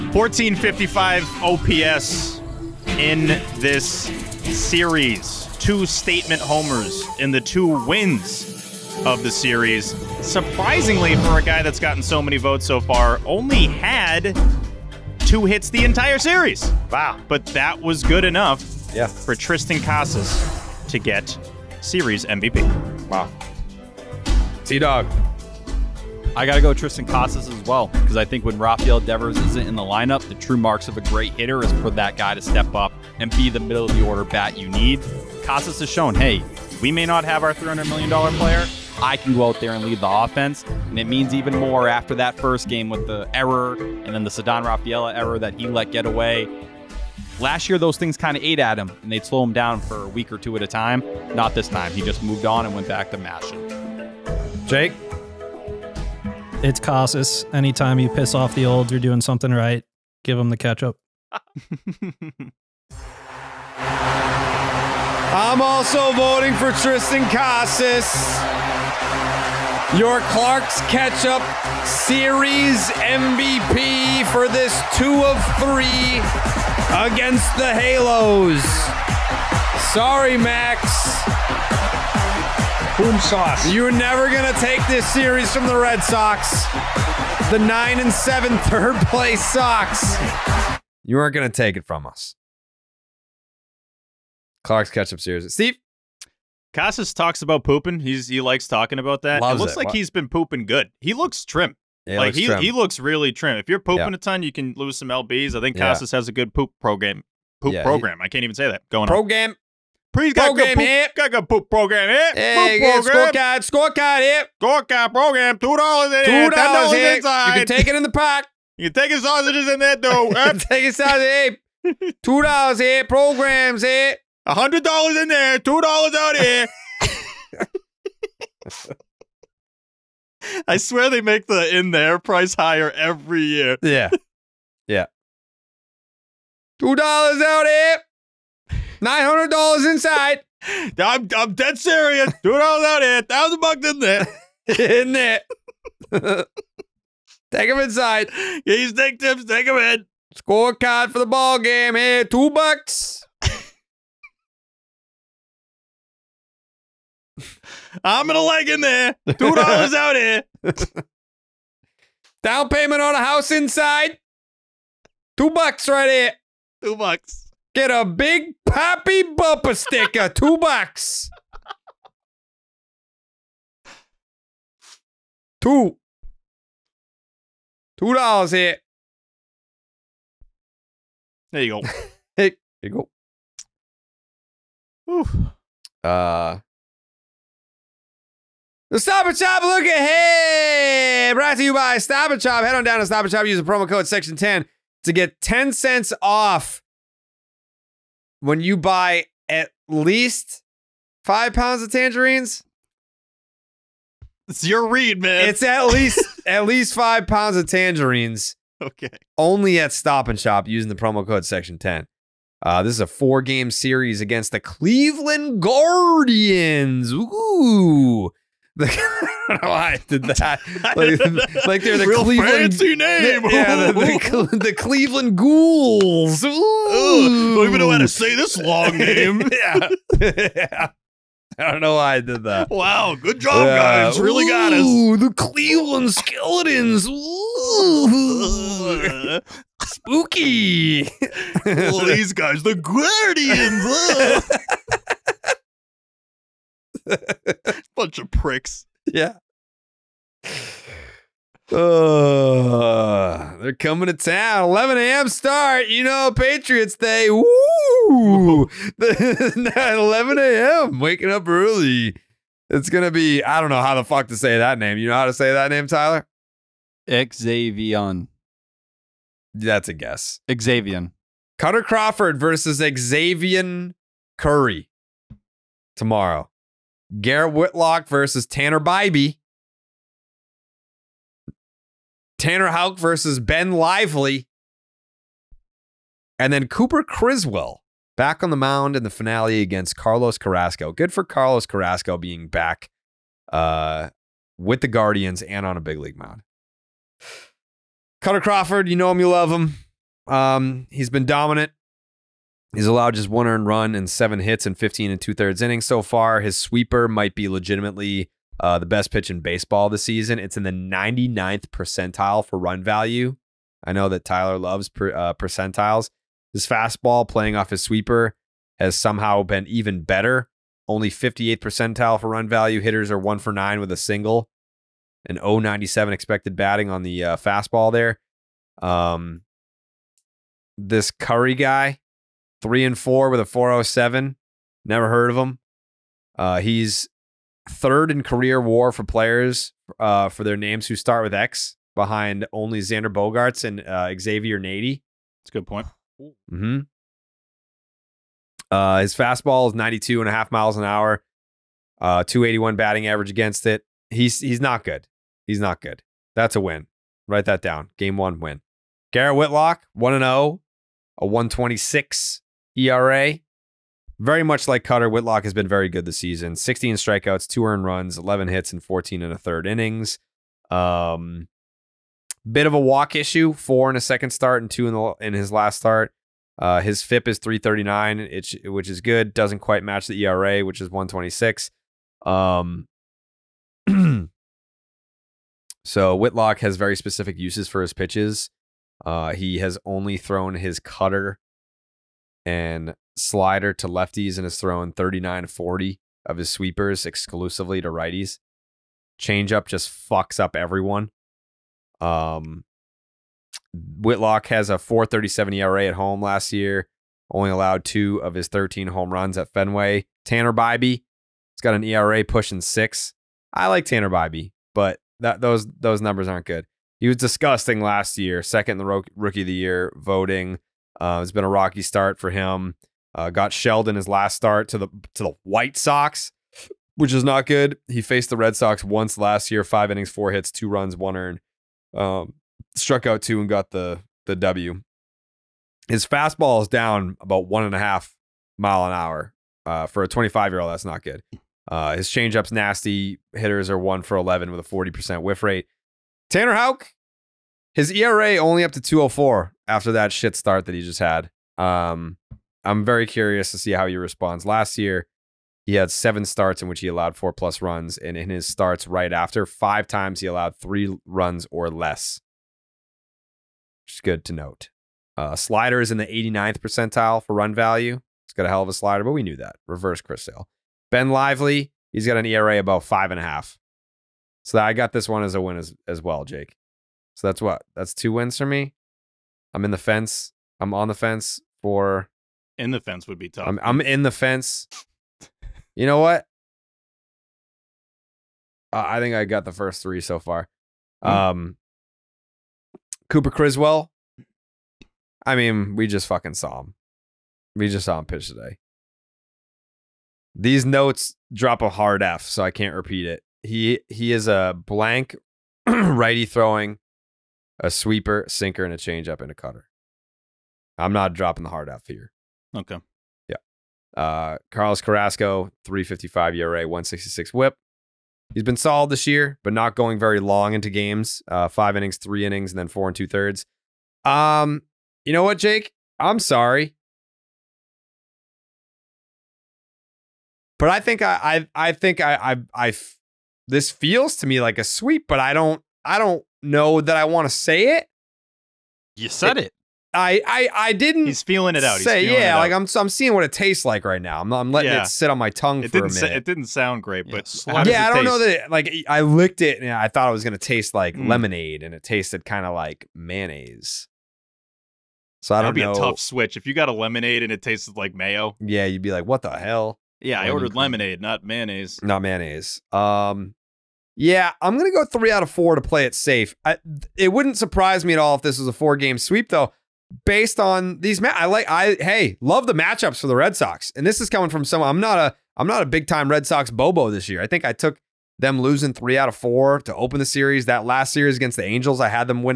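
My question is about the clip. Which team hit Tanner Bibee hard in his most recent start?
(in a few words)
White Sox.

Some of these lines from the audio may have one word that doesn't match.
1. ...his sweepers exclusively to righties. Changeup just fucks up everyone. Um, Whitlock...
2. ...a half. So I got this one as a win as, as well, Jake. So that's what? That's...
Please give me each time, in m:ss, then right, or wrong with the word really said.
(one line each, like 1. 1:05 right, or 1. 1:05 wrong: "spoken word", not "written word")
1. 6:36 right
2. 7:53 right.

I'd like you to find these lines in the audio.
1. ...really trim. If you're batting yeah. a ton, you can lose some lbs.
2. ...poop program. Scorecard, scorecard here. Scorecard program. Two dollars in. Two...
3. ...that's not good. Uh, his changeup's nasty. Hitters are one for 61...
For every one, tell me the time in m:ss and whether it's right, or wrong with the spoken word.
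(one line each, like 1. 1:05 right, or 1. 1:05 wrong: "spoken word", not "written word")
1. 1:42 wrong: "pooping", not "batting"
2. 1:52 right
3. 7:20 wrong: "11", not "61".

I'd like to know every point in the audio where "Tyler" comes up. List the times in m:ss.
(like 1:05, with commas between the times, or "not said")
4:25, 5:14.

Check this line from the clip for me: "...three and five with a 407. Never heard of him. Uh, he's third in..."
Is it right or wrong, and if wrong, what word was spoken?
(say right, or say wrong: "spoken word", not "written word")
wrong: "four", not "five".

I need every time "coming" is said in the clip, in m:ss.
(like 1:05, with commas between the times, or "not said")
4:13, 9:34.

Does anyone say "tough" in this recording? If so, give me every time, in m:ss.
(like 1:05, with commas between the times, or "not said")
8:03, 9:15.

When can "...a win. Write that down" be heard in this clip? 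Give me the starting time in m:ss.
5:56.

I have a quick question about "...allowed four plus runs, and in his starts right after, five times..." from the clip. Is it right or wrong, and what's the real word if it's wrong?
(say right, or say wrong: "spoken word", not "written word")
right.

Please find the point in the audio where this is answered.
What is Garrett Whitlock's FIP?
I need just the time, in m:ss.
6:17.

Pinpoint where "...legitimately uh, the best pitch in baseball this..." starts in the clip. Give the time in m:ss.
5:07.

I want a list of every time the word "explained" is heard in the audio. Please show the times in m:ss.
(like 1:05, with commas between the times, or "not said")
not said.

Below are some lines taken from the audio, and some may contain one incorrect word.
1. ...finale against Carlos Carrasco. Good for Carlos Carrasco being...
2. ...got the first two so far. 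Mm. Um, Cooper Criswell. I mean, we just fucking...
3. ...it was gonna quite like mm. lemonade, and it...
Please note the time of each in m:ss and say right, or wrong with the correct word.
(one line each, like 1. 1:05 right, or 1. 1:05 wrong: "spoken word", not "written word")
1. 4:49 right
2. 8:09 wrong: "three", not "two"
3. 9:10 wrong: "taste", not "quite".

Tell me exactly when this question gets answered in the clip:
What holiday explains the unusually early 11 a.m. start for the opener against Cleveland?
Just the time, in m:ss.
4:16.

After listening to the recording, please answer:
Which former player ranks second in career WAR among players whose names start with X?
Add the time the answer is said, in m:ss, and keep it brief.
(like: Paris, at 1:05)
Xavier Nady, at 5:44.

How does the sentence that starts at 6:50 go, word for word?
Tanner Bibee, has got an ERA pushing six.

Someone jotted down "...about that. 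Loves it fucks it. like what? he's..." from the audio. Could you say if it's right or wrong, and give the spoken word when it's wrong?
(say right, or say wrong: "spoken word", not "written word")
wrong: "looks", not "fucks".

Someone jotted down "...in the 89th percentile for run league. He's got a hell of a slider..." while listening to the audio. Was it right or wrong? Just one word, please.
wrong.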